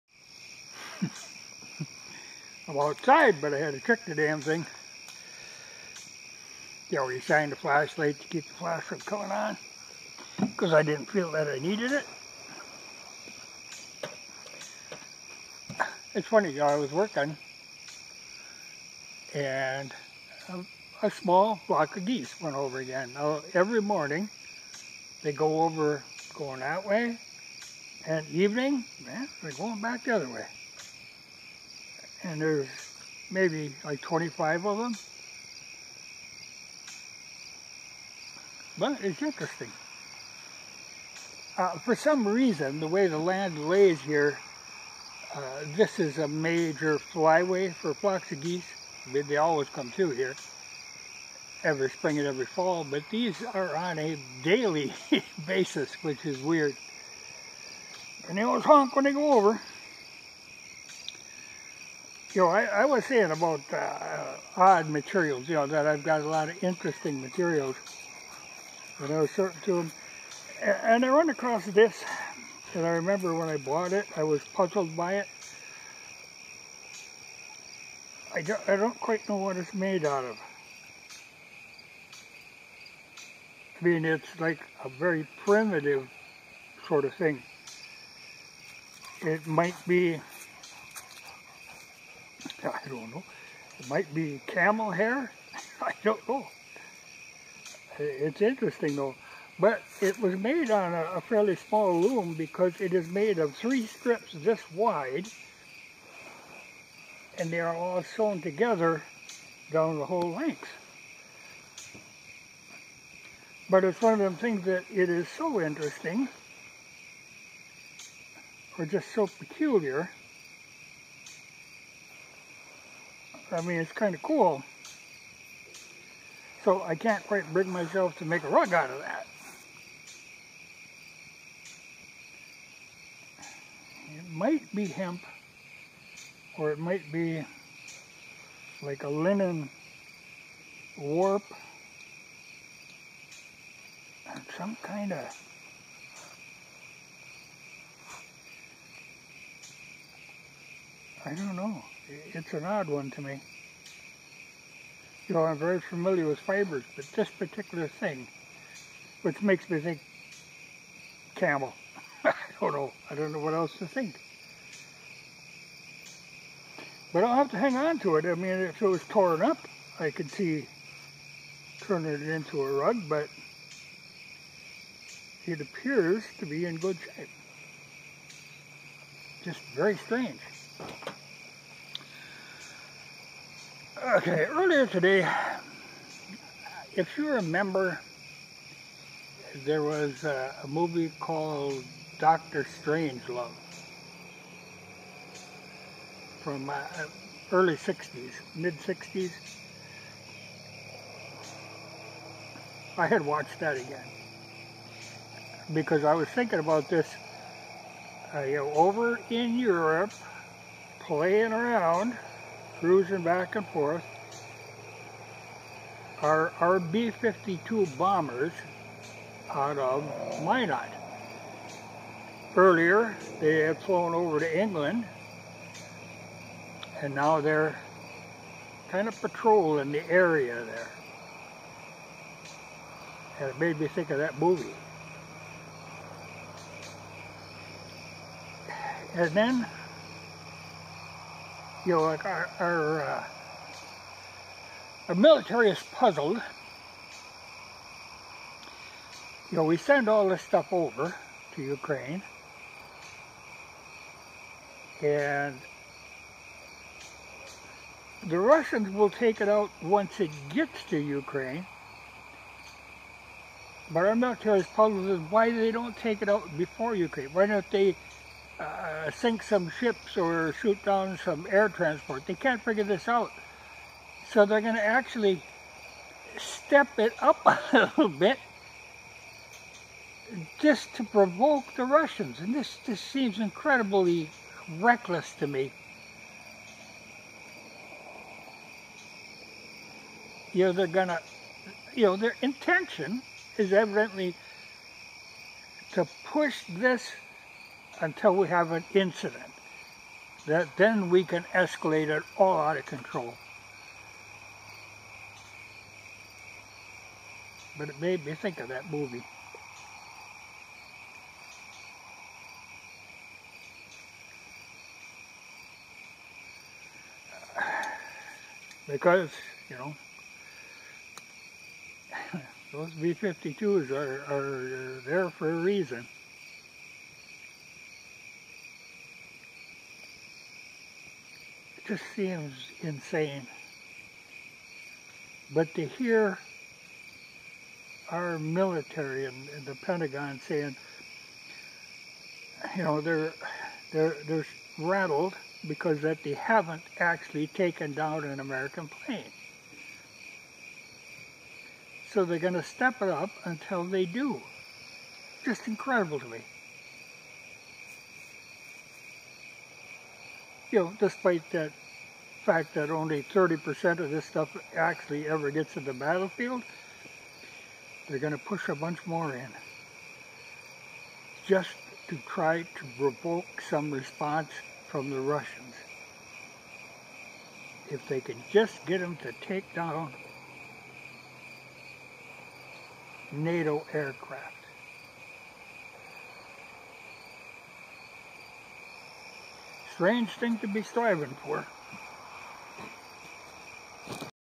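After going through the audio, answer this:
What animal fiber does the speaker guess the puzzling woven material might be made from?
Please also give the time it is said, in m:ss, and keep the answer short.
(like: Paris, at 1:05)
camel hair, at 1:34.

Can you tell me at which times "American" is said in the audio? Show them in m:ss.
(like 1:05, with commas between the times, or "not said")
5:48.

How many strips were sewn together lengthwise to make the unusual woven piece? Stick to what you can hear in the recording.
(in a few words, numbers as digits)
3.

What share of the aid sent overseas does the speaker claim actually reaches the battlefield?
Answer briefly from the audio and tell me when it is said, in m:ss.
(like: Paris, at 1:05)
30%, at 6:03.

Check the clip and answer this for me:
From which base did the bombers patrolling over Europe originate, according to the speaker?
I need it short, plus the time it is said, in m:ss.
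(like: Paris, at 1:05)
Minot, at 3:40.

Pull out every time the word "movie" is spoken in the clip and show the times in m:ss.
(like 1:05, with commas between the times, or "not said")
3:10, 3:54, 5:08.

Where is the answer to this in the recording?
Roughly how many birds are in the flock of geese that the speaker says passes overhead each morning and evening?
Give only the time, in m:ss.
0:34.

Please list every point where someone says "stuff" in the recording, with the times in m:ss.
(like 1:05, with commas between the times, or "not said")
4:10, 6:04.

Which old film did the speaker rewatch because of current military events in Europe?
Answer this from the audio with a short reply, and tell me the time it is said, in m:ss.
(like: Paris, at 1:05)
Doctor Strangelove, at 3:12.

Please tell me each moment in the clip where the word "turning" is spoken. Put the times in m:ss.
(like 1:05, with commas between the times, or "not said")
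2:51.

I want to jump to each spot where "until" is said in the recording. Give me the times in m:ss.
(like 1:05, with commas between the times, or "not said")
4:58, 5:53.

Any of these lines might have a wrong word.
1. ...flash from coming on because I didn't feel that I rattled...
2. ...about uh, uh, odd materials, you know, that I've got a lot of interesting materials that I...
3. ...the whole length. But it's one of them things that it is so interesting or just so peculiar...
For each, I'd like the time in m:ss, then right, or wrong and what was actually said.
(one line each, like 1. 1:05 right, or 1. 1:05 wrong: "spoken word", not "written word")
1. 0:08 wrong: "needed", not "rattled"
2. 1:03 right
3. 1:49 right.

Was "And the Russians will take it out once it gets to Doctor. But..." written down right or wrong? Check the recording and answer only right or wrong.
wrong.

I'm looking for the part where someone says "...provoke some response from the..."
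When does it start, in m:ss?
6:12.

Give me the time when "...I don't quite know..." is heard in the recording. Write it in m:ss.
1:18.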